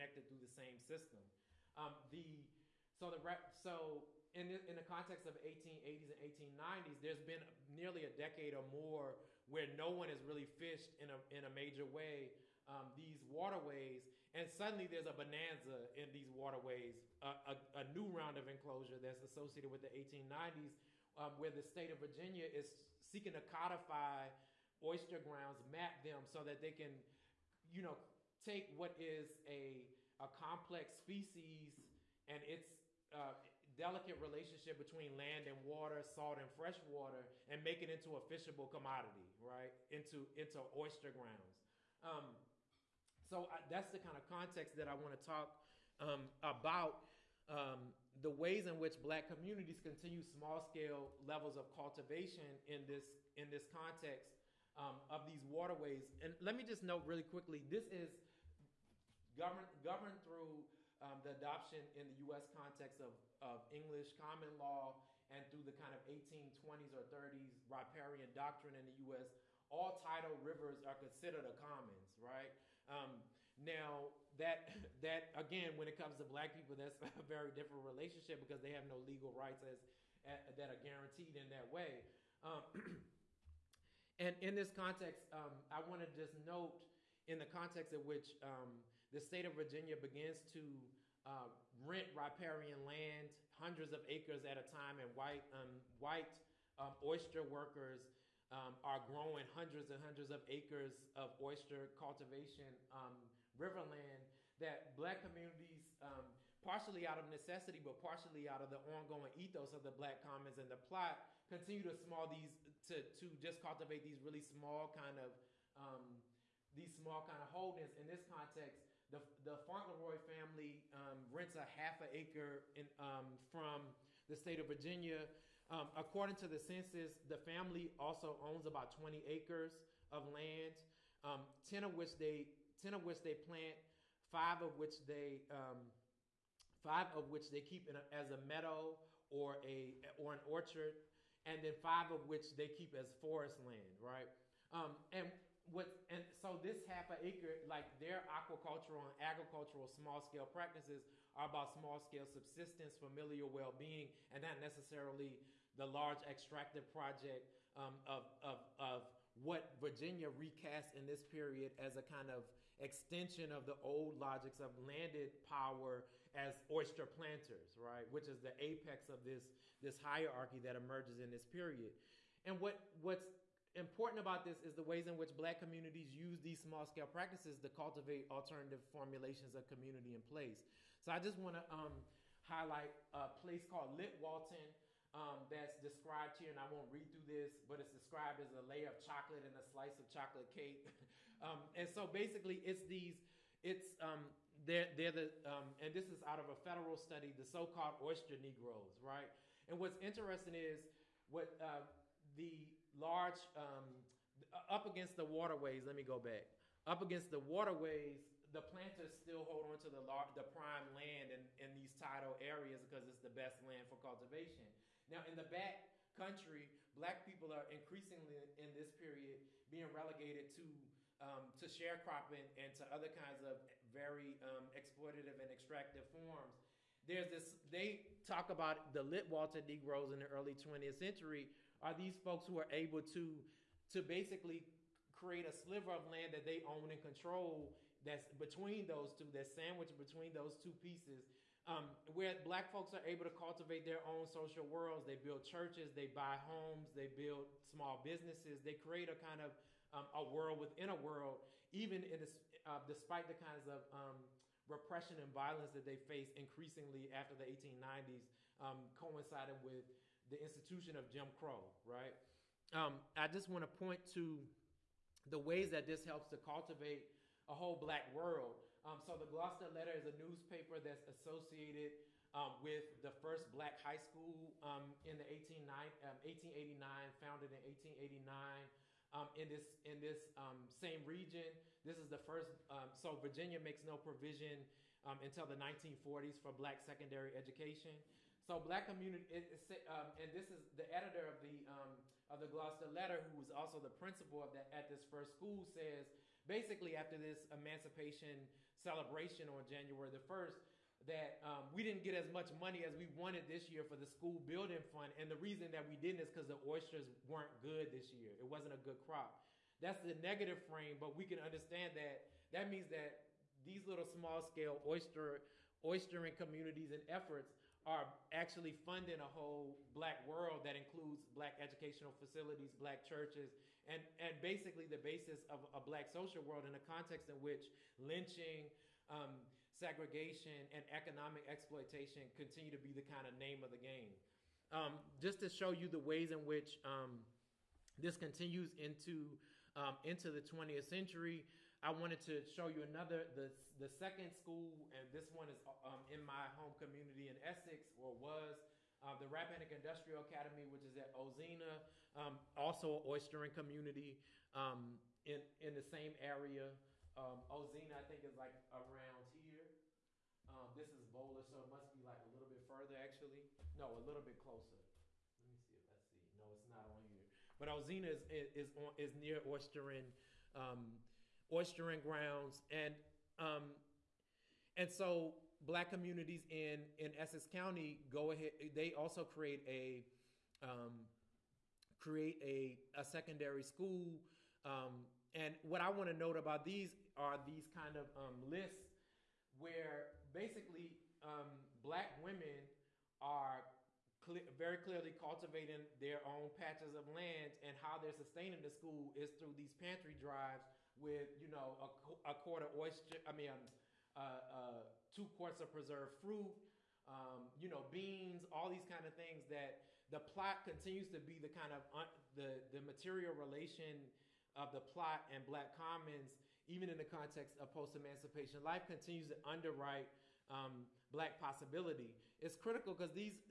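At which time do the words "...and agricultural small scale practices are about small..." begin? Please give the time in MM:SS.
02:29.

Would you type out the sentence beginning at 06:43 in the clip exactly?
I mean, um, uh, uh, two quarts of preserved fruit.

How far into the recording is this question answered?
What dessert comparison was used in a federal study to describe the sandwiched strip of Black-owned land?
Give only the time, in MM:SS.
03:10.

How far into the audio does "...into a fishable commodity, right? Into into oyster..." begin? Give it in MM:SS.
00:37.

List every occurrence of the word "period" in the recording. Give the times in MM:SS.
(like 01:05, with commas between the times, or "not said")
02:41, 02:51, 03:38.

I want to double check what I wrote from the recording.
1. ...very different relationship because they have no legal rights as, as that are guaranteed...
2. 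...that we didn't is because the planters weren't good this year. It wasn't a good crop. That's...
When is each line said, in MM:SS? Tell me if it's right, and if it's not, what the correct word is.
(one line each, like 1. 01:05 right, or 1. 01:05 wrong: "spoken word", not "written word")
1. 01:17 right
2. 05:05 wrong: "oysters", not "planters".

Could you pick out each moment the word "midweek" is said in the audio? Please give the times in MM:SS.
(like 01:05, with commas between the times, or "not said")
not said.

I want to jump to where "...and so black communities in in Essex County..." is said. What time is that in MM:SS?
06:14.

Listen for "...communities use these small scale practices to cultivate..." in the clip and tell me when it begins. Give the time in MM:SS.
02:55.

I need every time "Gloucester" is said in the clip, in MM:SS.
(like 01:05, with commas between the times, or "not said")
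04:29, 04:52.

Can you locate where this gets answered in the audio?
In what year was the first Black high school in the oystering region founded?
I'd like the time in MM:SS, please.
04:37.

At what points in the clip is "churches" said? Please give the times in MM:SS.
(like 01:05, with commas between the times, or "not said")
04:05, 05:23.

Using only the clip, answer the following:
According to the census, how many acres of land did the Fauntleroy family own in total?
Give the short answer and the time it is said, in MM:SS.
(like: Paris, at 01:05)
20 acres, at 02:08.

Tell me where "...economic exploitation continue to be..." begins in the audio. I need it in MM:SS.
05:30.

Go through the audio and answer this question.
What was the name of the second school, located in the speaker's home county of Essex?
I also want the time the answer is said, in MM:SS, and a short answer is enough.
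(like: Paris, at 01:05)
Rappahannock Industrial Academy, at 05:49.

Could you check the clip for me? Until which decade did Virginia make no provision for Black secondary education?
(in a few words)
1940s.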